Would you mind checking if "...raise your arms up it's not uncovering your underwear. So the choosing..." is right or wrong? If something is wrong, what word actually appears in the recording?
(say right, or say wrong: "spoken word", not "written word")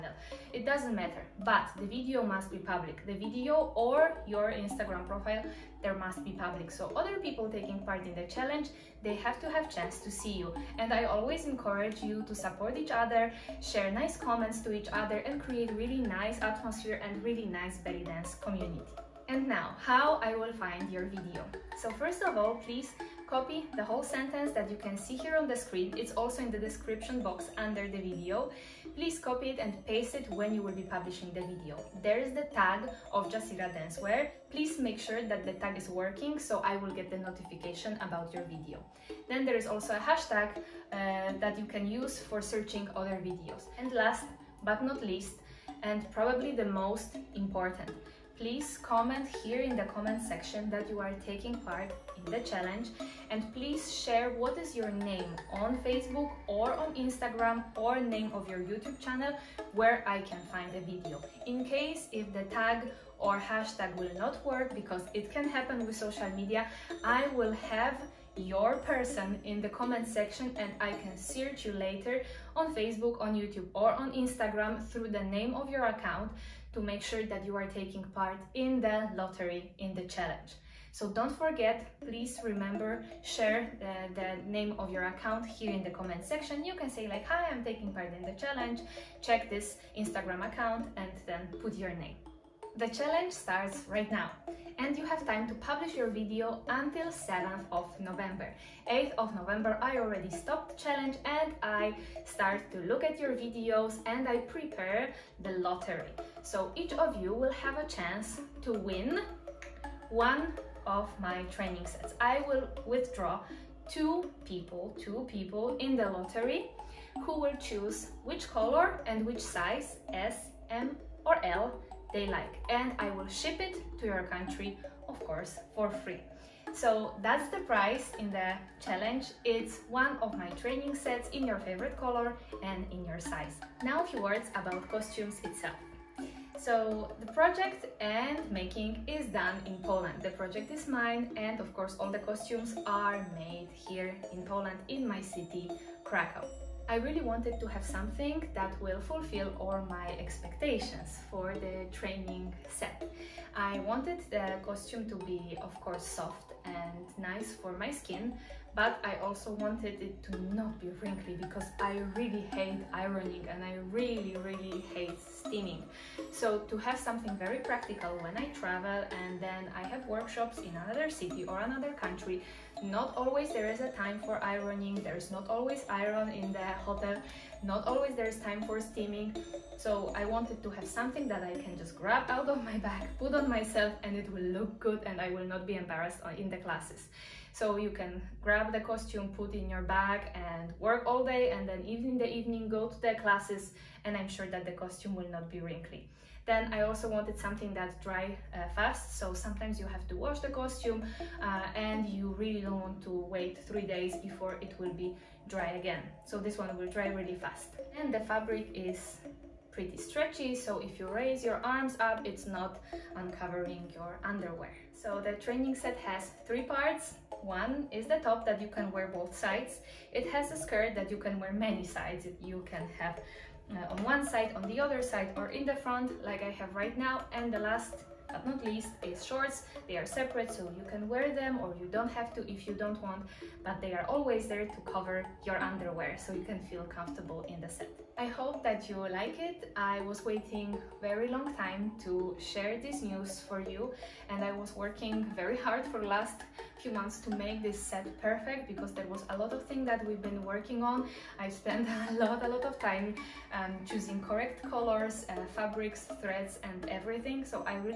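wrong: "training", not "choosing".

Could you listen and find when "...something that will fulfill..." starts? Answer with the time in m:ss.
2:27.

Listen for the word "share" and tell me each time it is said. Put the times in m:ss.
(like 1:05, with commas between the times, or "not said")
0:13, 0:53, 1:23, 4:02.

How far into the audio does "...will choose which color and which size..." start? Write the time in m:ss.
1:57.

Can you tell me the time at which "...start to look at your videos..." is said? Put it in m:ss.
1:42.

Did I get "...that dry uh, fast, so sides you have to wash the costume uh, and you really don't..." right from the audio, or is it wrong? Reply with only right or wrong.
wrong.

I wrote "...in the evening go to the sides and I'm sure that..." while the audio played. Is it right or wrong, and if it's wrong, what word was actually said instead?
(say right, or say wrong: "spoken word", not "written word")
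wrong: "classes", not "sides".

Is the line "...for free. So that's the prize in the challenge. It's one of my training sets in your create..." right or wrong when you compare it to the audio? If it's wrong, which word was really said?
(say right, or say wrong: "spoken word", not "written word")
wrong: "favorite", not "create".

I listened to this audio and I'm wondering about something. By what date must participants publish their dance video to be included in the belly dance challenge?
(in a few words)
7th of November.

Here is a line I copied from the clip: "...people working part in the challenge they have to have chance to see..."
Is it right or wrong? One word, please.
wrong.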